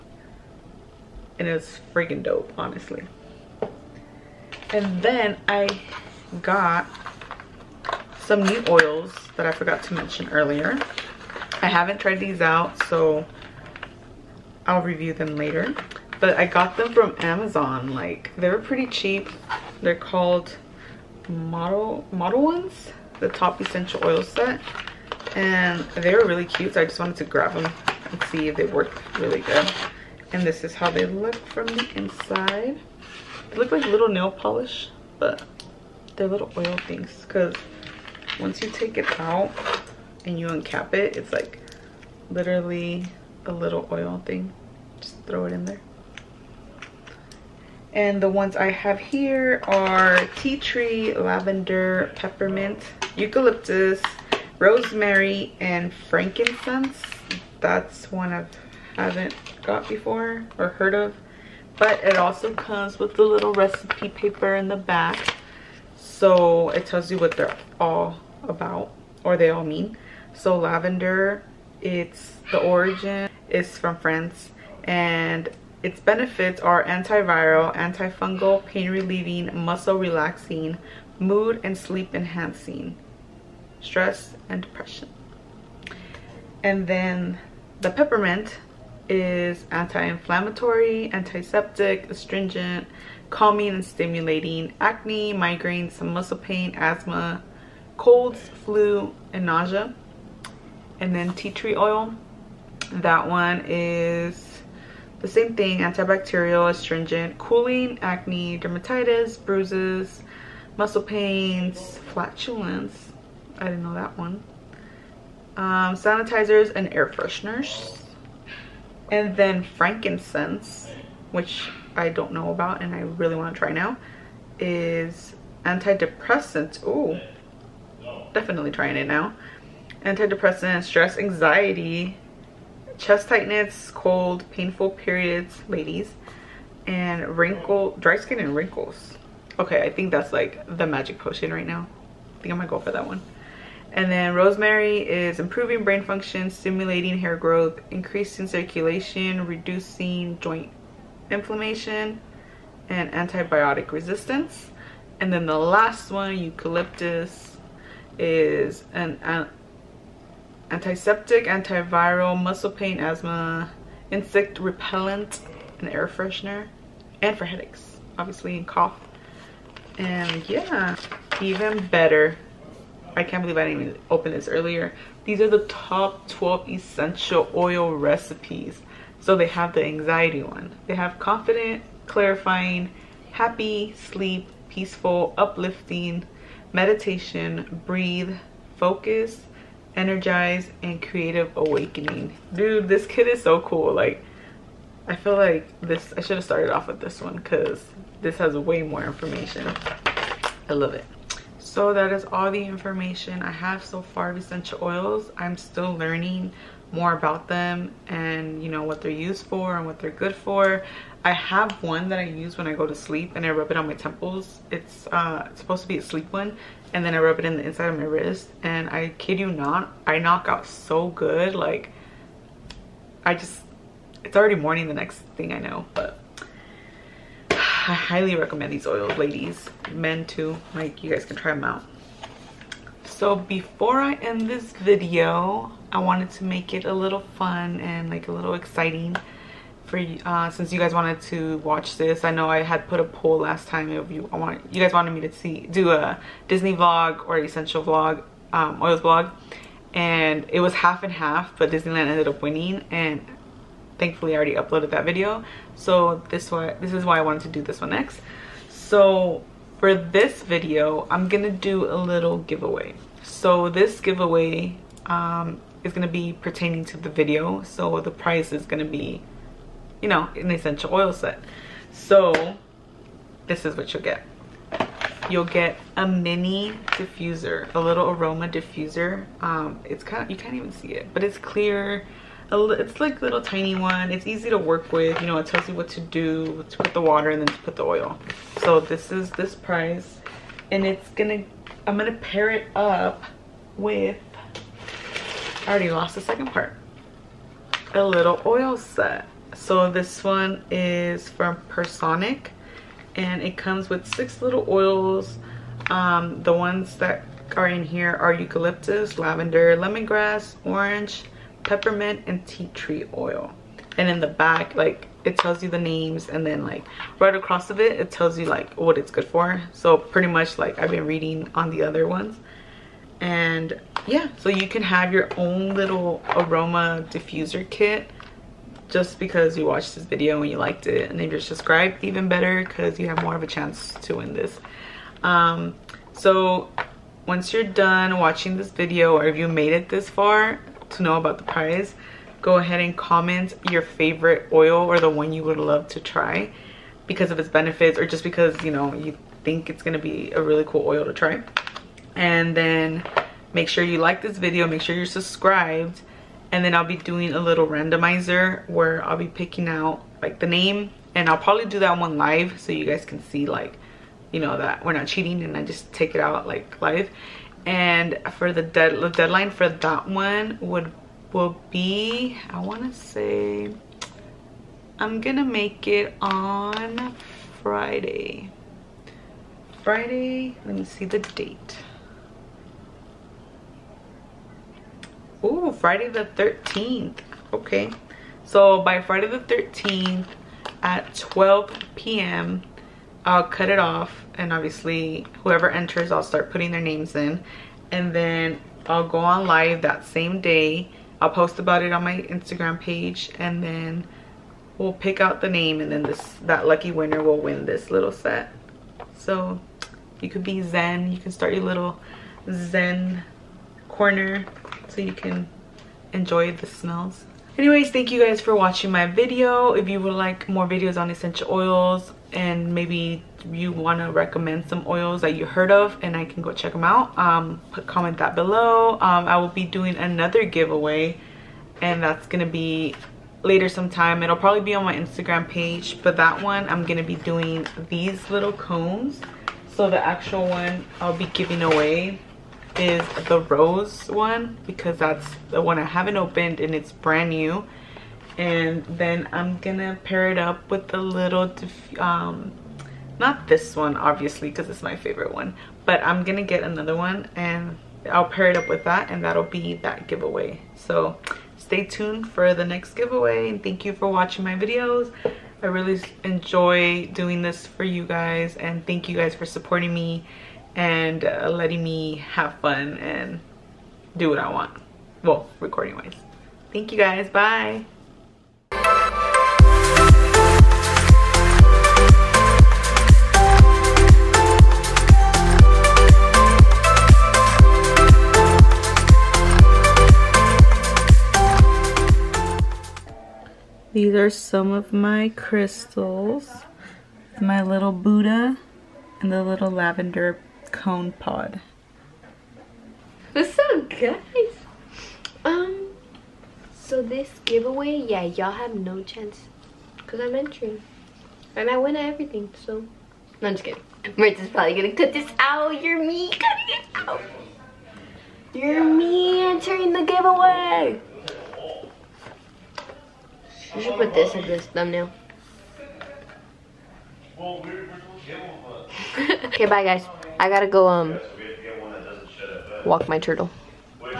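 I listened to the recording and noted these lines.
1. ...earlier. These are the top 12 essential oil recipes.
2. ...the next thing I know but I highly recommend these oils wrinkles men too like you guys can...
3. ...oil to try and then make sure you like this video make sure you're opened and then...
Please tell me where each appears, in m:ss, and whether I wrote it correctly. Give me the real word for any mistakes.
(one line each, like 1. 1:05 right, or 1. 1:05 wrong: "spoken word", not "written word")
1. 2:54 right
2. 3:44 wrong: "ladies", not "wrinkles"
3. 5:50 wrong: "subscribed", not "opened".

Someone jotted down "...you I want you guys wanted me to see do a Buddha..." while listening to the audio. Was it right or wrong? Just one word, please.
wrong.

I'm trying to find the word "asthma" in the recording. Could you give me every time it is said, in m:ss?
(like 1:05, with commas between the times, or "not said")
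1:36, 2:42.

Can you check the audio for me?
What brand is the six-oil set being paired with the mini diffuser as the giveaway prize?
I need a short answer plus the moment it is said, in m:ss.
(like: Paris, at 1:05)
Personic, at 5:01.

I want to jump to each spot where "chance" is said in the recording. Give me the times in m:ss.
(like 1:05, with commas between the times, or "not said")
5:33, 8:29.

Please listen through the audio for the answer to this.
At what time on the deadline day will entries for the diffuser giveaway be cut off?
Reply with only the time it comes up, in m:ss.
6:31.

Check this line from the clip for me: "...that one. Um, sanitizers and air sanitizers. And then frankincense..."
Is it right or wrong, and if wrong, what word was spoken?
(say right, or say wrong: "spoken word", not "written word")
wrong: "fresheners", not "sanitizers".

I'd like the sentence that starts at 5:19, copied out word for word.
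So pretty much like I've been reading on the other ones.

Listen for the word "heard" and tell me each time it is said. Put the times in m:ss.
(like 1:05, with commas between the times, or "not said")
1:00, 7:05.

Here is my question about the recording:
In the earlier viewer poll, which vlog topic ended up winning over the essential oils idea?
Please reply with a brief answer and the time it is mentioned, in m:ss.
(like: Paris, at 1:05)
Disneyland, at 4:11.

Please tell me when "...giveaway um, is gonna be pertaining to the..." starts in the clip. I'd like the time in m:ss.
4:24.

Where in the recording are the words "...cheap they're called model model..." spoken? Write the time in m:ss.
0:18.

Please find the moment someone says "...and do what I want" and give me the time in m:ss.
7:52.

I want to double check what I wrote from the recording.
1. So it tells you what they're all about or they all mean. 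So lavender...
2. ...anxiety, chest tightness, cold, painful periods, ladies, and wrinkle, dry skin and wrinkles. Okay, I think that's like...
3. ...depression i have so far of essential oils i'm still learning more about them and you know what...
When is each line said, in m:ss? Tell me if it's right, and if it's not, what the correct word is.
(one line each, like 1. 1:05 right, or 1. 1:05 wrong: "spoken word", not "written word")
1. 1:05 right
2. 2:11 right
3. 3:22 wrong: "information", not "depression".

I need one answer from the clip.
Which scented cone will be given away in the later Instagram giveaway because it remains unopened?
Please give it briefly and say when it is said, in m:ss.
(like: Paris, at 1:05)
Rose, at 7:23.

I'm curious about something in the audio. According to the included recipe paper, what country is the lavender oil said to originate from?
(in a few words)
France.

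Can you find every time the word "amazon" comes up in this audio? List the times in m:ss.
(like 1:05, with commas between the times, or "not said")
0:17.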